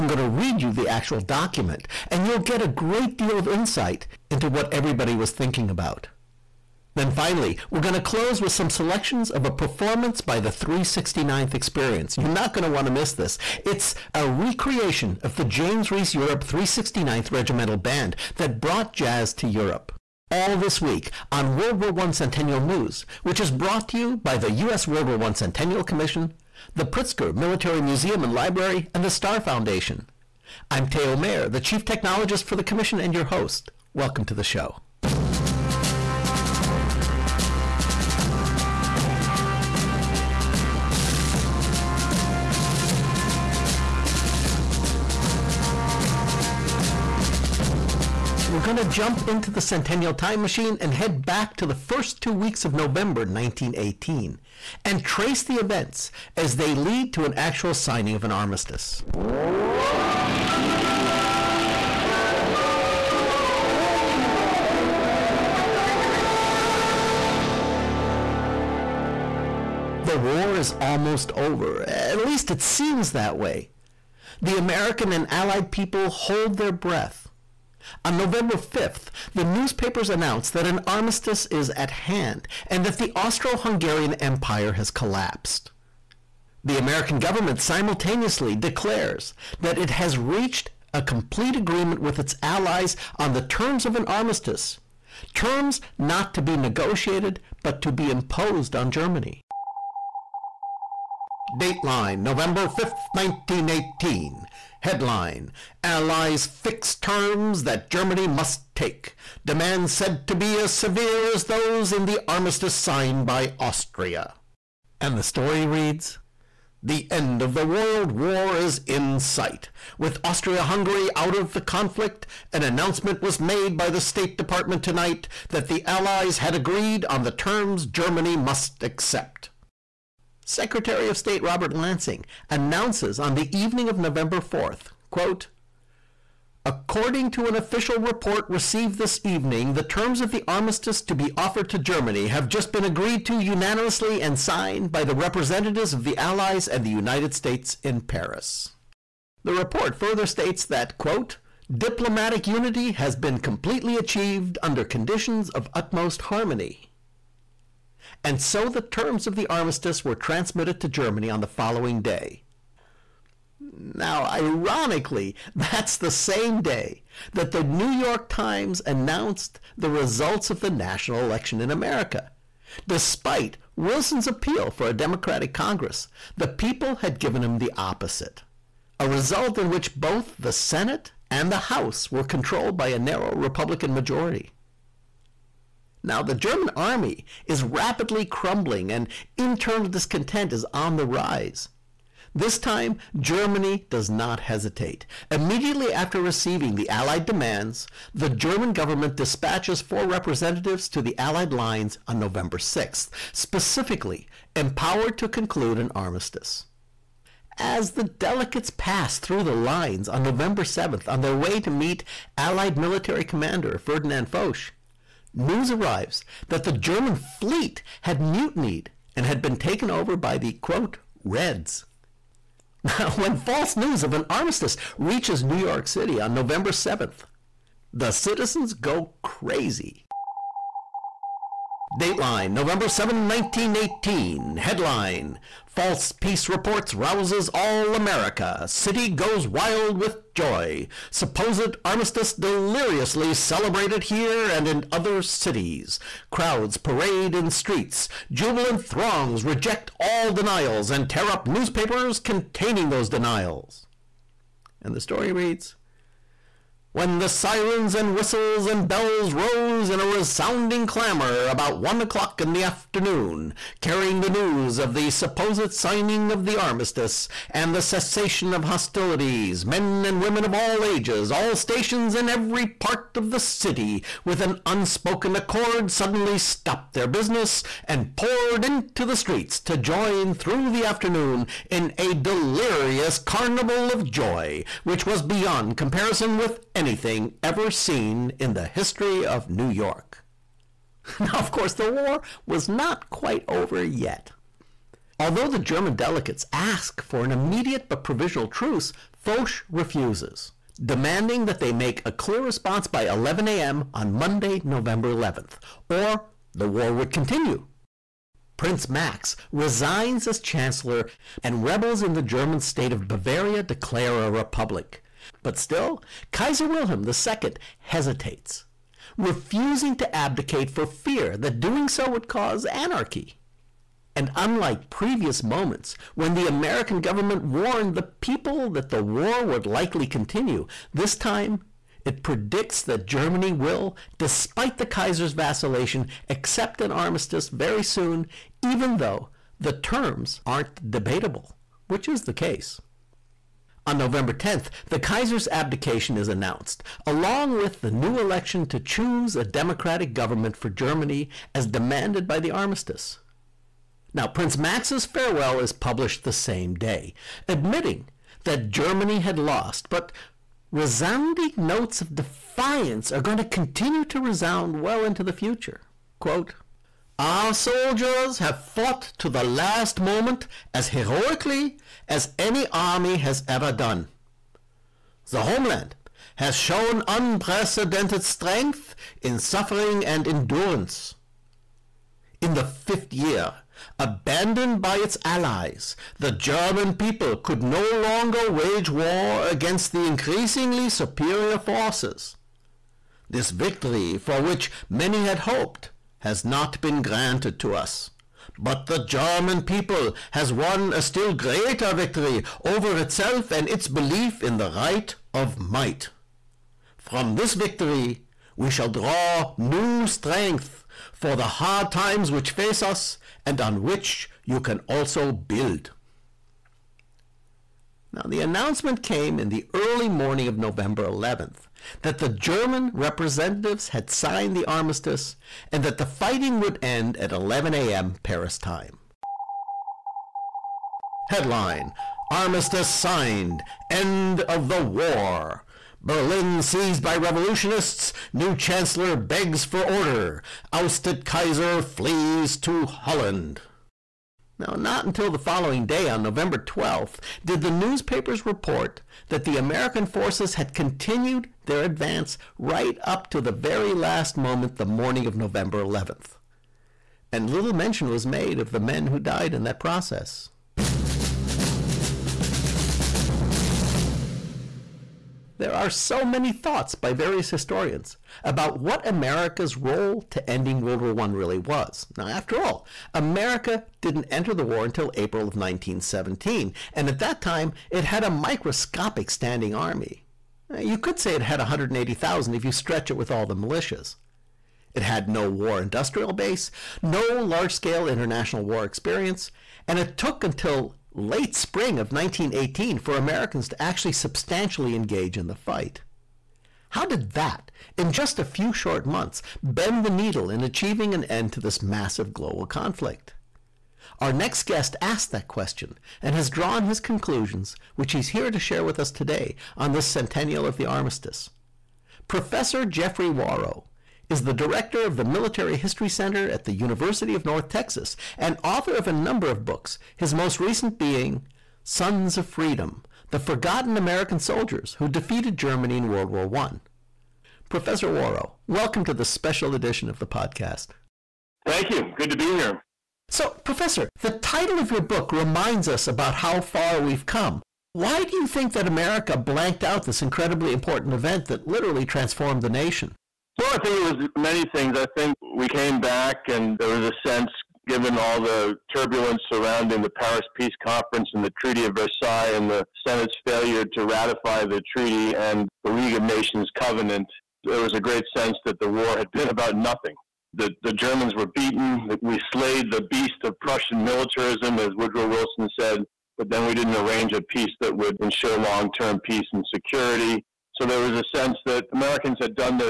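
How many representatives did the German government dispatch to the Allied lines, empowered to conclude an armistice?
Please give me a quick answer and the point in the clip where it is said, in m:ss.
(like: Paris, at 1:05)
4, at 3:19.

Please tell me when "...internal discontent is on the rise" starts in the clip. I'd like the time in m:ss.
3:09.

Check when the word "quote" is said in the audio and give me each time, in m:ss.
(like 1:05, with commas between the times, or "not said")
2:15, 2:30, 3:40, 6:06.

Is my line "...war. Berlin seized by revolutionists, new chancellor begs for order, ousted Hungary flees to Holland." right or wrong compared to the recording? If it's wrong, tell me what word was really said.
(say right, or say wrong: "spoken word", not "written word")
wrong: "Kaiser", not "Hungary".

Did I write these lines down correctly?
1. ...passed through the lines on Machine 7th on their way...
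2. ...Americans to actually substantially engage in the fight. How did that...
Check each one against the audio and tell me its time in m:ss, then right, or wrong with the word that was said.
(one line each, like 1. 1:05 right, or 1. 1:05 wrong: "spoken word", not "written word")
1. 3:28 wrong: "November", not "Machine"
2. 8:13 right.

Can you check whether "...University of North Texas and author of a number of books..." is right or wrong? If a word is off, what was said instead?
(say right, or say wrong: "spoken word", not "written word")
right.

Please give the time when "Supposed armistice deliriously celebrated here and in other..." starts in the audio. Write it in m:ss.
4:01.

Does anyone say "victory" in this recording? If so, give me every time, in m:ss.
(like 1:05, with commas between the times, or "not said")
6:33, 6:41, 6:47.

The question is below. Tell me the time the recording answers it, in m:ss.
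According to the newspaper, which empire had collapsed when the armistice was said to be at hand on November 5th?
1:23.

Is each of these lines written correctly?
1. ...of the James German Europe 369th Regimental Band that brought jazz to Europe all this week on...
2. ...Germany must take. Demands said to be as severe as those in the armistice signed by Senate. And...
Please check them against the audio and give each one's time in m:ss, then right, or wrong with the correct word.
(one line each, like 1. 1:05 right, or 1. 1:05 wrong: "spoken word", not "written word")
1. 0:15 wrong: "Reese", not "German"
2. 1:47 wrong: "Austria", not "Senate".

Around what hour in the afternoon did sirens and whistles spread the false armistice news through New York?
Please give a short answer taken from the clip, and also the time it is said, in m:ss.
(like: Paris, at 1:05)
1 o'clock, at 4:21.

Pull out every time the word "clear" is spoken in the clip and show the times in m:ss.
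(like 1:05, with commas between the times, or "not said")
5:02.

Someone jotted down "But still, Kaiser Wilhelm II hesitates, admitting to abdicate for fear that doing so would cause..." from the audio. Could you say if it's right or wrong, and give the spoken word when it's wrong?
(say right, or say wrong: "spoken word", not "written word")
wrong: "refusing", not "admitting".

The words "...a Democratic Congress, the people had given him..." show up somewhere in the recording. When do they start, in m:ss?
2:54.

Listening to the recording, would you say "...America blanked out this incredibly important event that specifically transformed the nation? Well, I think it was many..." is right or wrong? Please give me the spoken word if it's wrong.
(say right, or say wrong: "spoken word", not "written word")
wrong: "literally", not "specifically".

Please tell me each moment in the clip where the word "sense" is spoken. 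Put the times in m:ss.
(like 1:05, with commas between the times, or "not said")
9:07, 9:18, 9:31.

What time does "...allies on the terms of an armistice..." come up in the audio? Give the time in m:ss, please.
1:32.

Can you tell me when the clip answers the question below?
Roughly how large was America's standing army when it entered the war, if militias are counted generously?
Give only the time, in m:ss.
8:01.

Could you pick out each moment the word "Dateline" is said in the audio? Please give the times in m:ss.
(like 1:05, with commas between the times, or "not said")
1:41, 3:51.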